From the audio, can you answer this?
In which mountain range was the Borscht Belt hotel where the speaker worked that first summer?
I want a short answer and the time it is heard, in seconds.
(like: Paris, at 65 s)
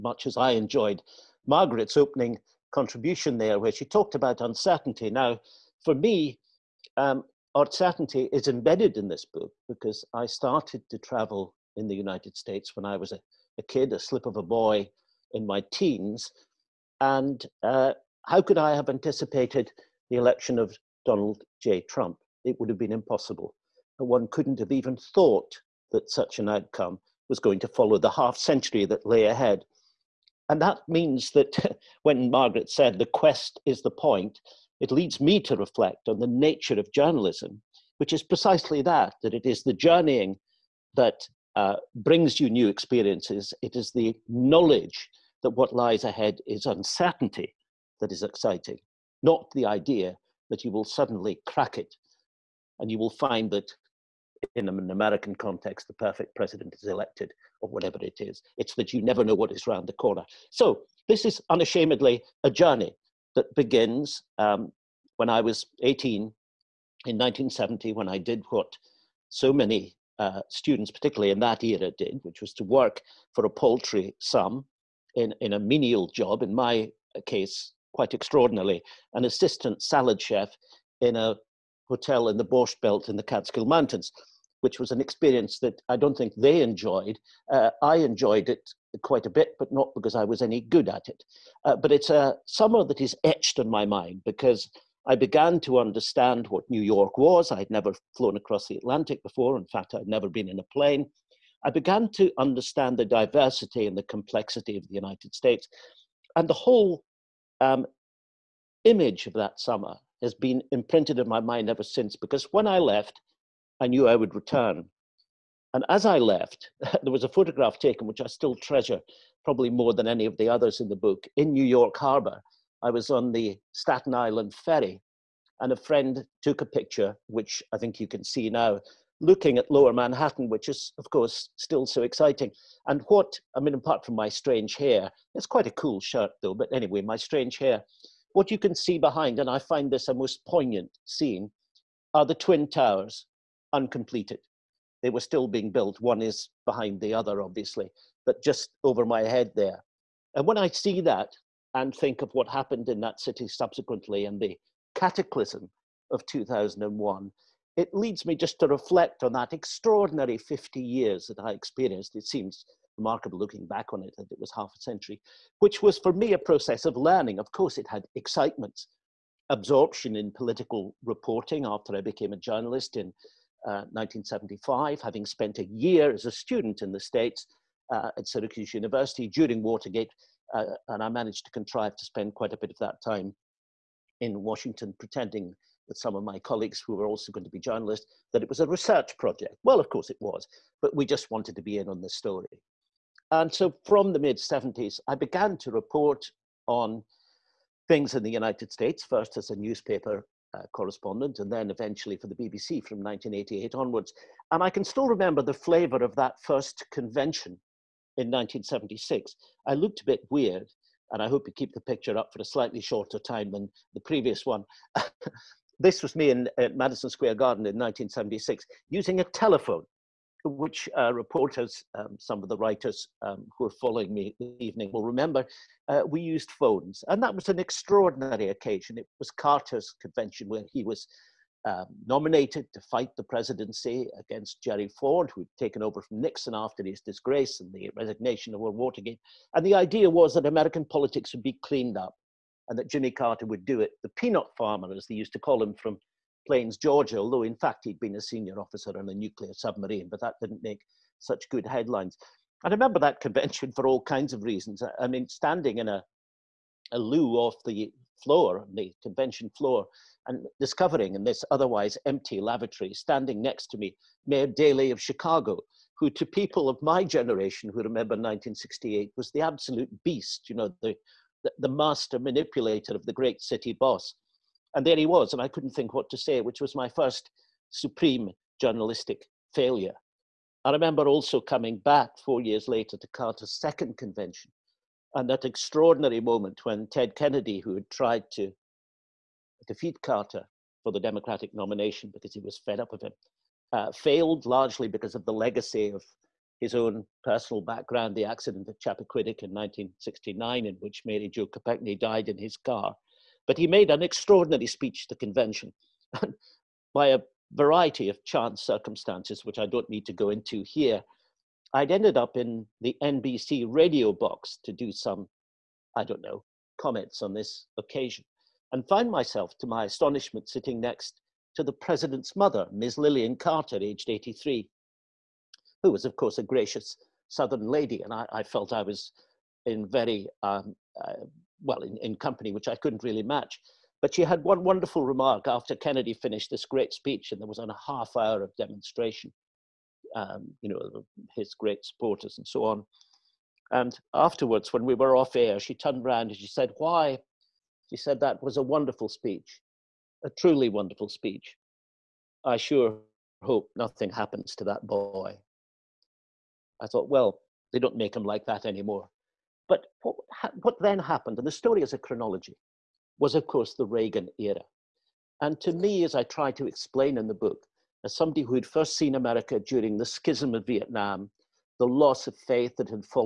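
Catskill Mountains, at 83 s.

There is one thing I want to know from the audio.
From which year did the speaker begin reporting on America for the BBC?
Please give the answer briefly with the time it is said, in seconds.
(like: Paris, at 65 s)
1988, at 203 s.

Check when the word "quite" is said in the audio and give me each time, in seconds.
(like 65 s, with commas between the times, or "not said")
77 s, 89 s, 135 s, 182 s.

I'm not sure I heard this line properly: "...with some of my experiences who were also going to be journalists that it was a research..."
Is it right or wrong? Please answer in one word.
wrong.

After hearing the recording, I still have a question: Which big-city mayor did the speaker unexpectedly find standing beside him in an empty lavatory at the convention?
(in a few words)
Mayor Daley.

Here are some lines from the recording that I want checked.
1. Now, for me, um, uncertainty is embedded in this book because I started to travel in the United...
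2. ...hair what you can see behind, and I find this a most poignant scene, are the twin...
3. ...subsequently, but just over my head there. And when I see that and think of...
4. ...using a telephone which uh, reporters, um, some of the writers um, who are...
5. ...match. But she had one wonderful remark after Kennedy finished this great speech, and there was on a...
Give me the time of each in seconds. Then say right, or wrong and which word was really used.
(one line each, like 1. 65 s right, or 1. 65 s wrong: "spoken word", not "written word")
1. 5 s right
2. 137 s right
3. 147 s wrong: "obviously", not "subsequently"
4. 218 s right
5. 333 s right.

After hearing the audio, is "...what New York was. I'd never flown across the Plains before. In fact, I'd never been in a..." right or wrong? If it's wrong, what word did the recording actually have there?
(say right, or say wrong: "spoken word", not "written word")
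wrong: "Atlantic", not "Plains".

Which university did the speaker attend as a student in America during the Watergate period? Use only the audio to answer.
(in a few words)
Syracuse University.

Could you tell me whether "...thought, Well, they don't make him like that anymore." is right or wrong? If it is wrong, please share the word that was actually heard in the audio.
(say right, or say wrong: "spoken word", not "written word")
right.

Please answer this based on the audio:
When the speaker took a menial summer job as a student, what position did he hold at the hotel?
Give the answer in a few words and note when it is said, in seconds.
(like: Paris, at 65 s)
Assistant salad chef, at 79 s.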